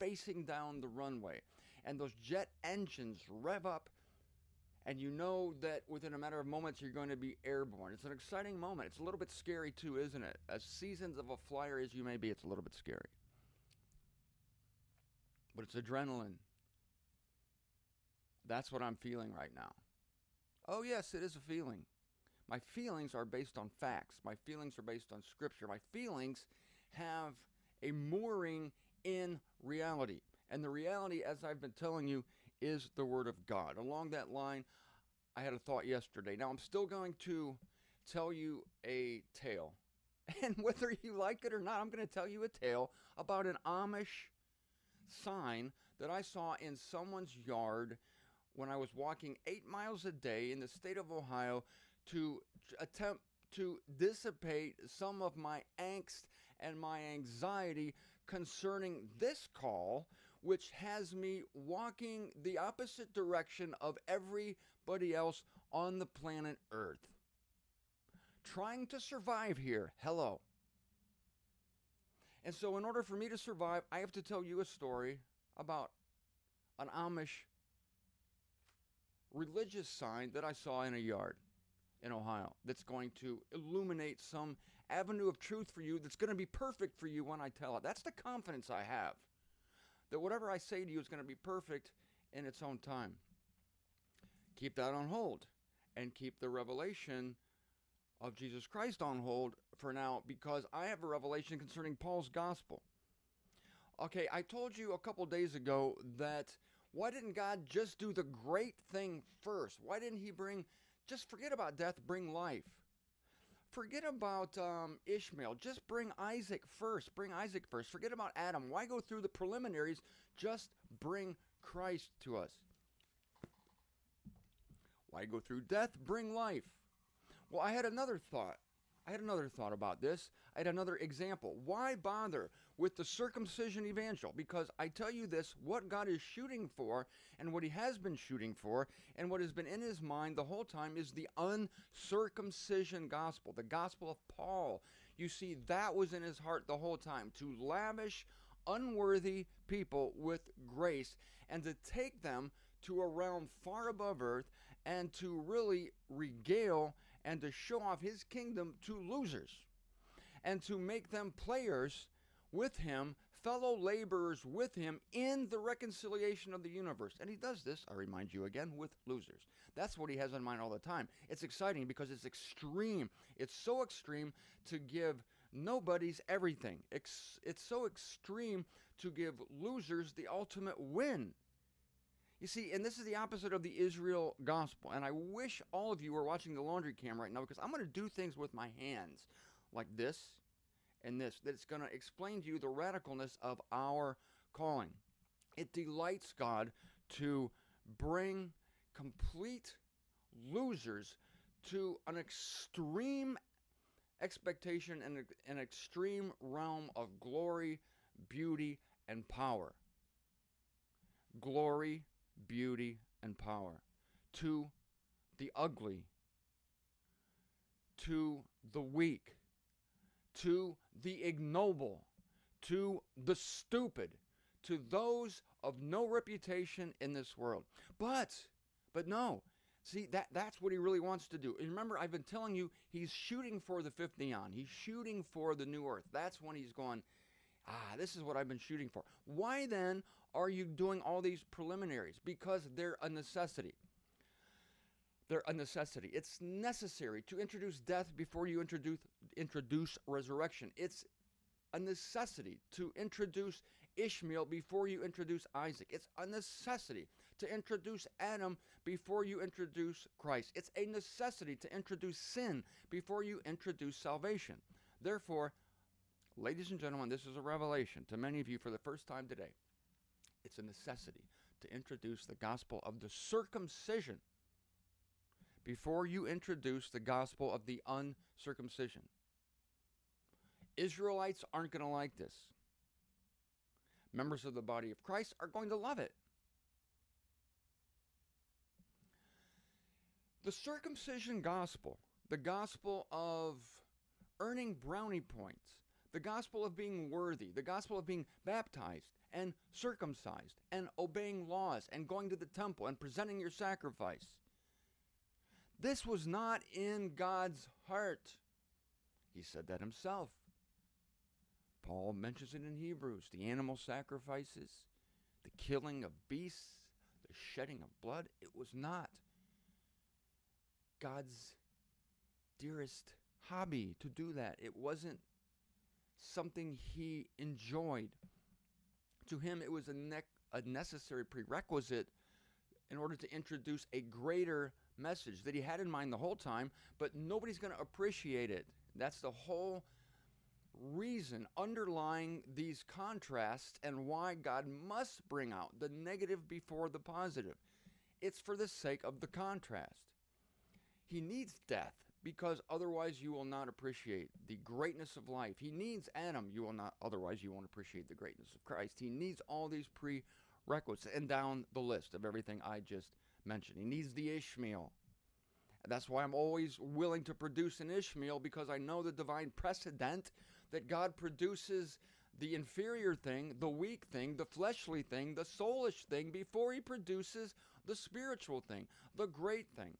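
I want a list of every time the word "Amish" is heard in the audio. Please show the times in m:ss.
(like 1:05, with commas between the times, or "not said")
0:43, 1:16.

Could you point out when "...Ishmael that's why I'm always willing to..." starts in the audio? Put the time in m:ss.
6:04.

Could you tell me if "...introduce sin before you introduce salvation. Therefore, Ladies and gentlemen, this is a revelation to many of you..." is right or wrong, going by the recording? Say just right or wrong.
right.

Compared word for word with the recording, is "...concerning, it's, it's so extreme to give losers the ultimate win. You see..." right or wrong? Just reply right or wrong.
wrong.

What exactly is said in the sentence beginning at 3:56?
That's when he's going, ah, this is what I've been shooting for.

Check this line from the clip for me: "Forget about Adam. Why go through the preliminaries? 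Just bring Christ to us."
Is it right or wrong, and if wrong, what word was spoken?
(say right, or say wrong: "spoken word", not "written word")
right.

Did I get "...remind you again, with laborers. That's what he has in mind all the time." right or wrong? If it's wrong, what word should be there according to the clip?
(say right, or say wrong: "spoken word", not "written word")
wrong: "losers", not "laborers".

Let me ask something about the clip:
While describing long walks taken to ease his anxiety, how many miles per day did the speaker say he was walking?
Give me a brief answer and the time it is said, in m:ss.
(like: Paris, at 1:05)
8, at 0:49.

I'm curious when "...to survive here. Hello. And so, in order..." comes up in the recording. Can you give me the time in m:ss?
1:08.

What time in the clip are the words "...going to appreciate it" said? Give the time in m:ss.
5:37.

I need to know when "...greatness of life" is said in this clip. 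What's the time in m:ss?
5:54.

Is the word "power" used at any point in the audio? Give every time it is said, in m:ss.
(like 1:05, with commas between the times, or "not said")
3:29, 3:33.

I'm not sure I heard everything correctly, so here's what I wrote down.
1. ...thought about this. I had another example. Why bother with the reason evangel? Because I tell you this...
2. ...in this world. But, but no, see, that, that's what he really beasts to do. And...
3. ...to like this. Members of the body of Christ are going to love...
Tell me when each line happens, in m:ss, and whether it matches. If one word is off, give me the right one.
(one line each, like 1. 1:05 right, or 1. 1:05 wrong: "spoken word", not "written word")
1. 2:09 wrong: "circumcision", not "reason"
2. 3:46 wrong: "wants", not "beasts"
3. 4:41 right.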